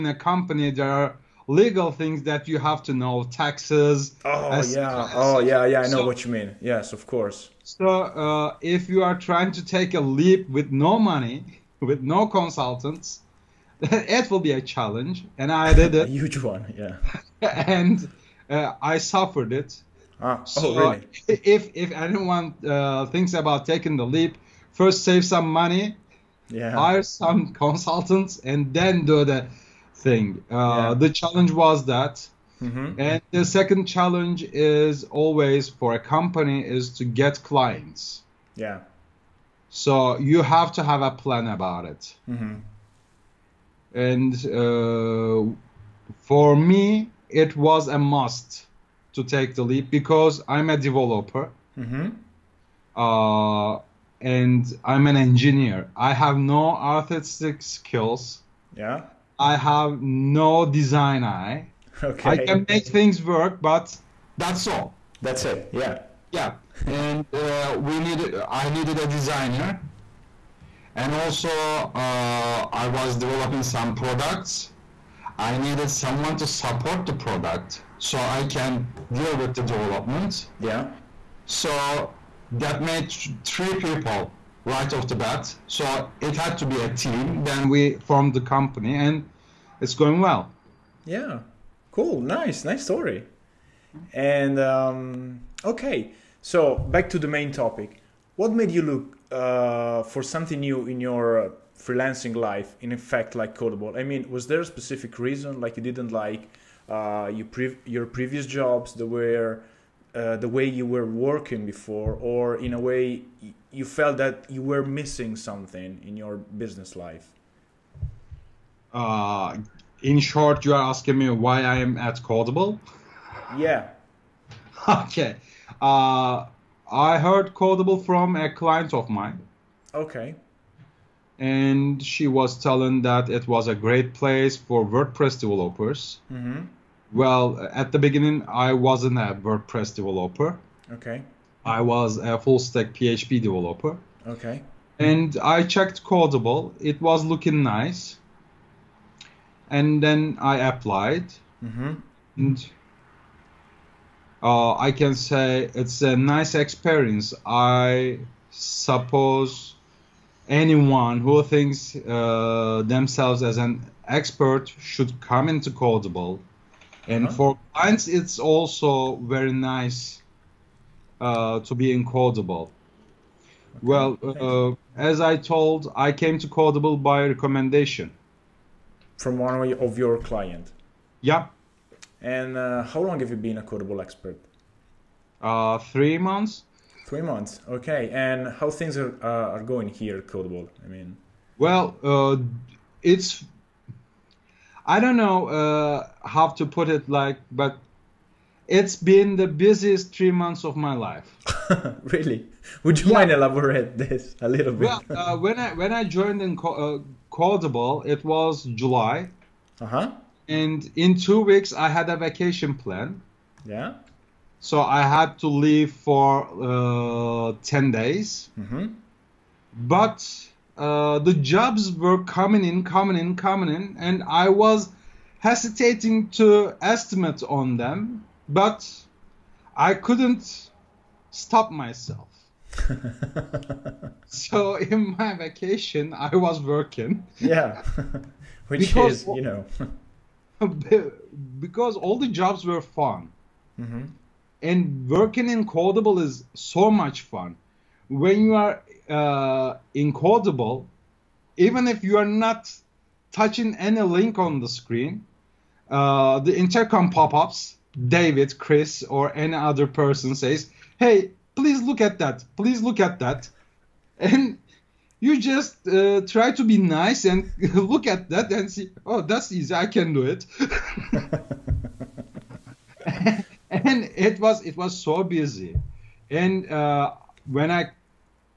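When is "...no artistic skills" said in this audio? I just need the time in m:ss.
0:56.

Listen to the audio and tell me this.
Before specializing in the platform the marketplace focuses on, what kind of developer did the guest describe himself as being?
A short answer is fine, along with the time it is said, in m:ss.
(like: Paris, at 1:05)
full stack PHP developer, at 2:22.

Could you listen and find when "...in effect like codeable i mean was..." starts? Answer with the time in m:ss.
1:42.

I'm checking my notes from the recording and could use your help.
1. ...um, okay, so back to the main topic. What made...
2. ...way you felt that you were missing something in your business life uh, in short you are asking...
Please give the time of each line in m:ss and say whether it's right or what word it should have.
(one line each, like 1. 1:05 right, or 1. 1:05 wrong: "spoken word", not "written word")
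1. 1:34 right
2. 1:52 right.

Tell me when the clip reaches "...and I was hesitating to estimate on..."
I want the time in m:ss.
3:43.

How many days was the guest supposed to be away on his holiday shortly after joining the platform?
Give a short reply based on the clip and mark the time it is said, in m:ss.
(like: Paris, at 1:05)
10, at 3:37.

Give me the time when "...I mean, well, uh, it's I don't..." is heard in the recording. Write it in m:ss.
3:10.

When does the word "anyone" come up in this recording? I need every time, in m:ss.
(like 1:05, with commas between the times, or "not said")
0:21, 2:40.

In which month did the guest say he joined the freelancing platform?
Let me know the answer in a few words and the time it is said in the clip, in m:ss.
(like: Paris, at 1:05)
July, at 3:28.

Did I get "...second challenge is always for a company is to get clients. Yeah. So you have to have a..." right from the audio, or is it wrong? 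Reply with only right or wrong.
right.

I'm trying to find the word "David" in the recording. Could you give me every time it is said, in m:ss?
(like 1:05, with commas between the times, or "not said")
4:18.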